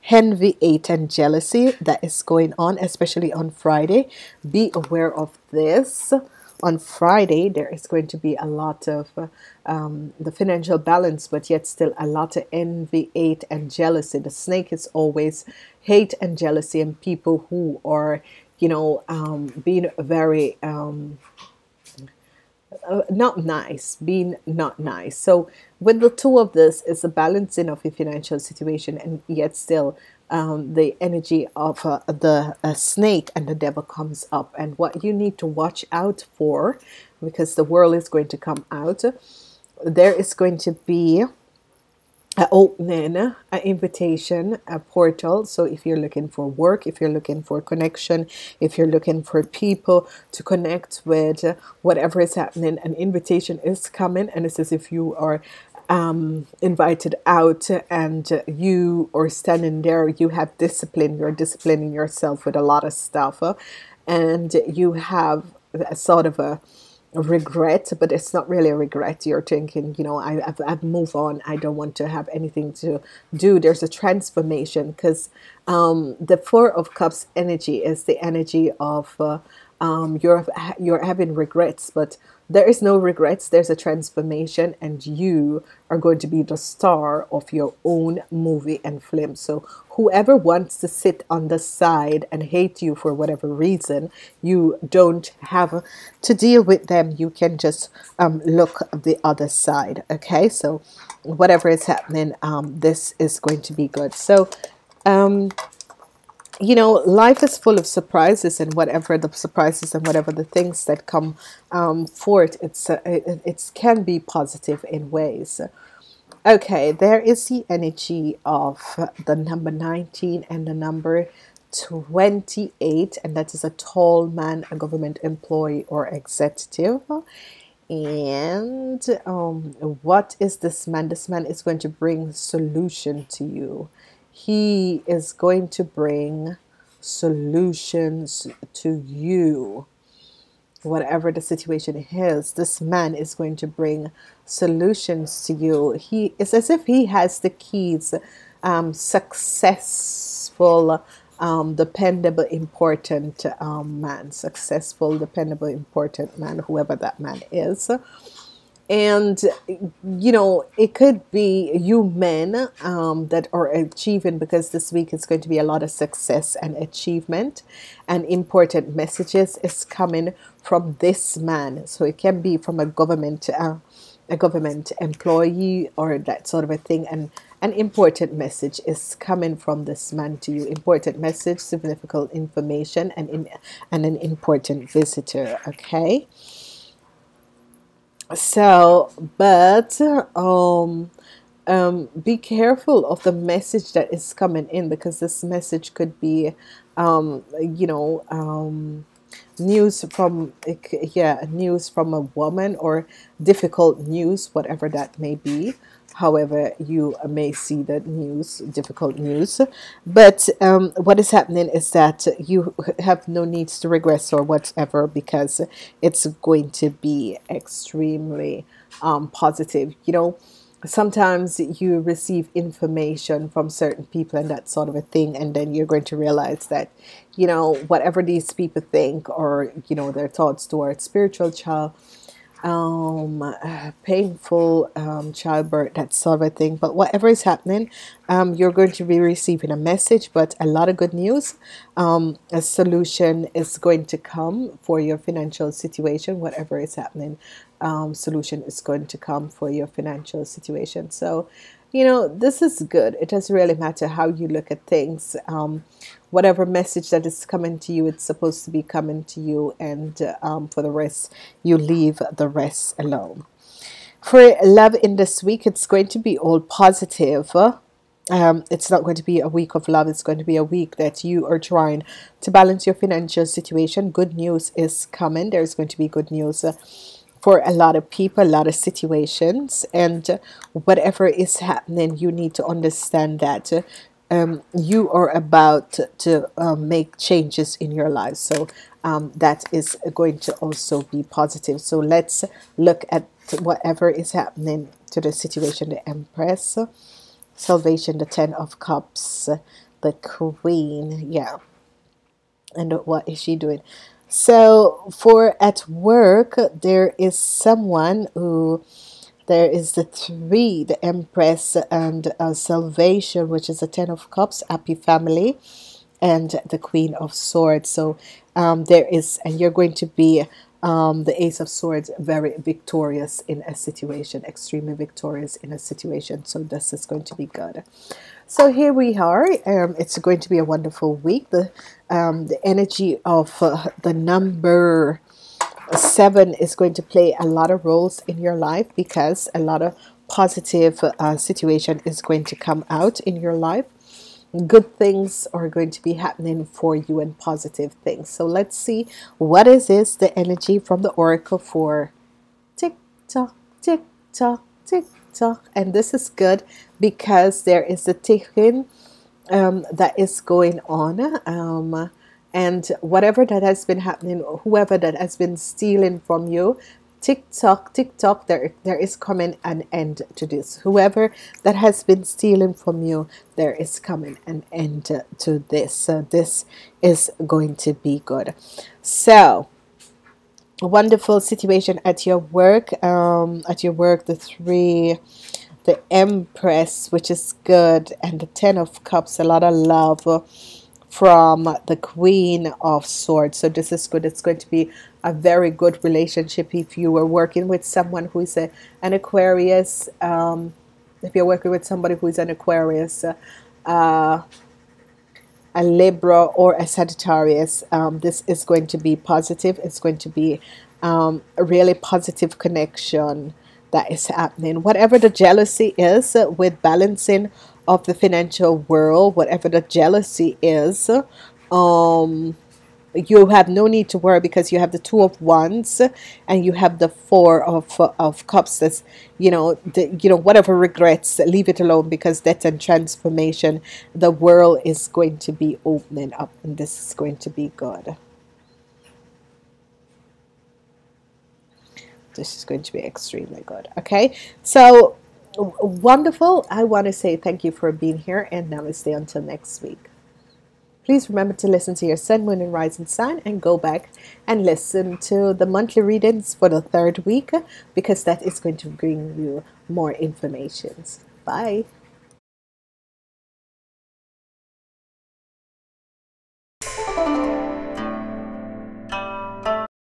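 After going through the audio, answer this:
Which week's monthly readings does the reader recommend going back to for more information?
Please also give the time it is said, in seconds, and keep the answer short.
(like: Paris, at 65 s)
The third week, at 456 s.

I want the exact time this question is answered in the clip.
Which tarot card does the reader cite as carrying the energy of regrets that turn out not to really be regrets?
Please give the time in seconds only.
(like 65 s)
76 s.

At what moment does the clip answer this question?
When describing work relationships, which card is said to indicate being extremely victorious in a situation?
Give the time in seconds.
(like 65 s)
321 s.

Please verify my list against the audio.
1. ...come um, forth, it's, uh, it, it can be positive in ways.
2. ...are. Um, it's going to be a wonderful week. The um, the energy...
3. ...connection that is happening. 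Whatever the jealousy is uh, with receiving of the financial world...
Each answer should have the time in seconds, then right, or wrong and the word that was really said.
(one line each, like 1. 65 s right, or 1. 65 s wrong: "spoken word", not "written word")
1. 111 s right
2. 329 s right
3. 412 s wrong: "balancing", not "receiving".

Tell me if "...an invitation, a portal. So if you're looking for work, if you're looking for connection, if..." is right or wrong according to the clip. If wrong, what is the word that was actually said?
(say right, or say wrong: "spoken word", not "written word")
right.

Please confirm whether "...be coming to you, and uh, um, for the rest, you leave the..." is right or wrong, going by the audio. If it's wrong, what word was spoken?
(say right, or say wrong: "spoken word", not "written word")
right.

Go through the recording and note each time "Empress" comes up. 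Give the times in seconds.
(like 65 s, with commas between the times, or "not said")
296 s, 311 s, 386 s.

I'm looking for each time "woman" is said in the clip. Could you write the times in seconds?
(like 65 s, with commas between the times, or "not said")
202 s.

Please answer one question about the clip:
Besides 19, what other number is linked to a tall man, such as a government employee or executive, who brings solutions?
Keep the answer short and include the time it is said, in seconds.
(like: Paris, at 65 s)
28, at 121 s.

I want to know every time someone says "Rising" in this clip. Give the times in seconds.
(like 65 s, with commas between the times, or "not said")
452 s.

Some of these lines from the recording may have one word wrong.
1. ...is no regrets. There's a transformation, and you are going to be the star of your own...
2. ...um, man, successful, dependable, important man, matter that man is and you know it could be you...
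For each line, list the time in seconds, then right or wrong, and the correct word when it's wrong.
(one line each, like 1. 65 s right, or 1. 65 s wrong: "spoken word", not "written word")
1. 82 s right
2. 153 s wrong: "whoever", not "matter".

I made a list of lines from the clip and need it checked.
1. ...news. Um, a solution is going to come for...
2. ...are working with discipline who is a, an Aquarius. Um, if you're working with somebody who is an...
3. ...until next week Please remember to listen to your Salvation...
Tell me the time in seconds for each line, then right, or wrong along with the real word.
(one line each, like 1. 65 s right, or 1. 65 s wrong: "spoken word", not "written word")
1. 241 s right
2. 397 s wrong: "someone", not "discipline"
3. 449 s wrong: "Sun", not "Salvation".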